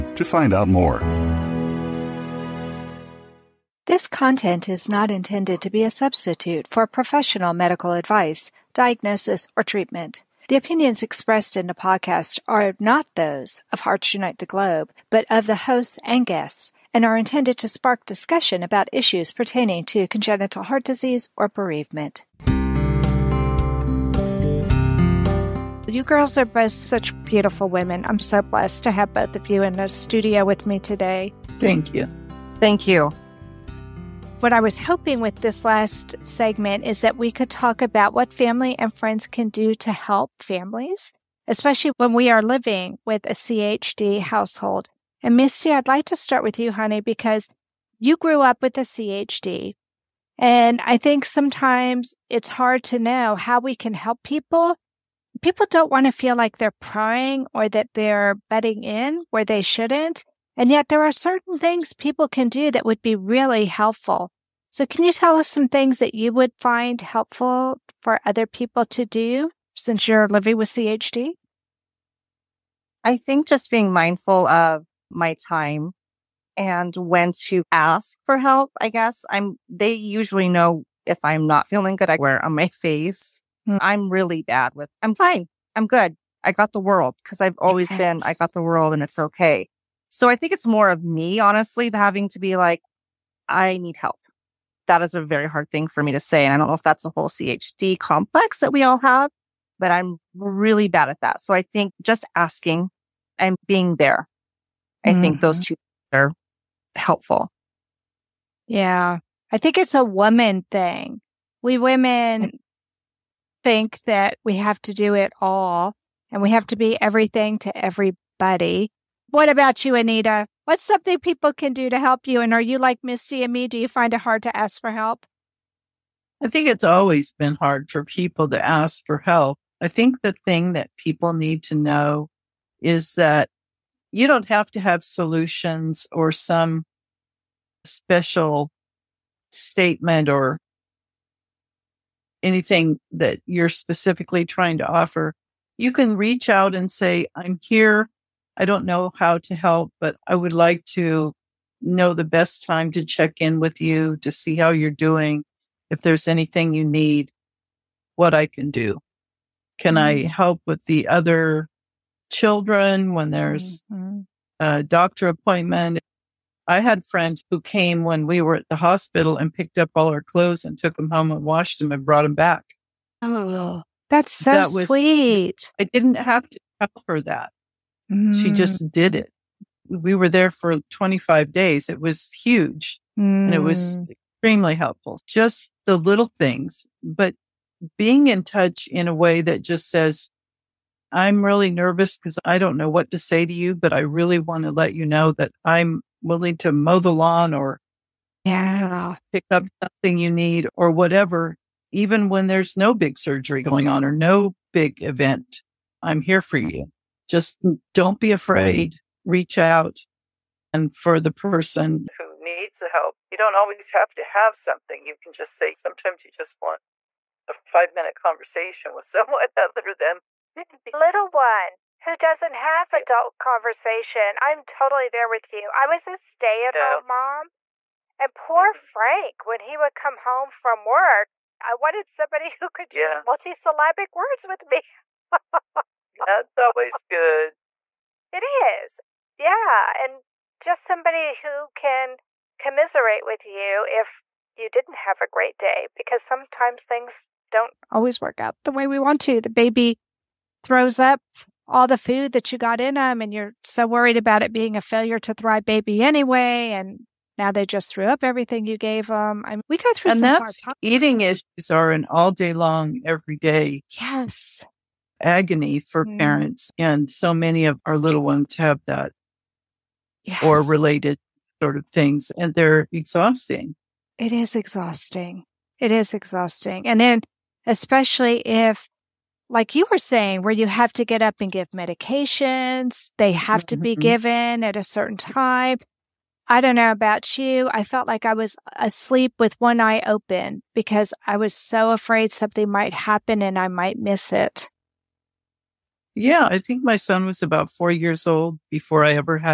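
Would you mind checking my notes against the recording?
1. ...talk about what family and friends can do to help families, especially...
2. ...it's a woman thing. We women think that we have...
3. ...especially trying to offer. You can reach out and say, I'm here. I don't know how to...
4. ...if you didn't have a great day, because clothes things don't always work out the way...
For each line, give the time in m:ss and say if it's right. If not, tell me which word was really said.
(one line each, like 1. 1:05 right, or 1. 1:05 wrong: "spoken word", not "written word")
1. 0:37 right
2. 1:49 right
3. 2:23 wrong: "specifically", not "especially"
4. 4:03 wrong: "sometimes", not "clothes".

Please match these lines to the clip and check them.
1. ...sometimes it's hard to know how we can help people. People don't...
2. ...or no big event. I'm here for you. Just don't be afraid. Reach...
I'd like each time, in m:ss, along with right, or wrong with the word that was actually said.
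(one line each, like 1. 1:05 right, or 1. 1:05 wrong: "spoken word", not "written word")
1. 0:51 right
2. 3:24 right.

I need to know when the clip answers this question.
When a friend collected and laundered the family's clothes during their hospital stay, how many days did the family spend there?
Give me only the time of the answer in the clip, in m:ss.
3:00.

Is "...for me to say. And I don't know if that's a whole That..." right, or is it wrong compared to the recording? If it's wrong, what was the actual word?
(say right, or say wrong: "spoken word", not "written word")
wrong: "CHD", not "That".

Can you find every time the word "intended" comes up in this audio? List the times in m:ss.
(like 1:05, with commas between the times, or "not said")
0:05, 0:17.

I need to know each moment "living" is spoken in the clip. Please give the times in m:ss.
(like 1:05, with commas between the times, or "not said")
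0:42, 1:10.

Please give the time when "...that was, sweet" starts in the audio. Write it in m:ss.
2:54.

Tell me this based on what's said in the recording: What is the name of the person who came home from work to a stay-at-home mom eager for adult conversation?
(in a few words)
Frank.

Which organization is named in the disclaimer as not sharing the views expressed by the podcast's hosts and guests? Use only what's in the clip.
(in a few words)
Hearts Unite the Globe.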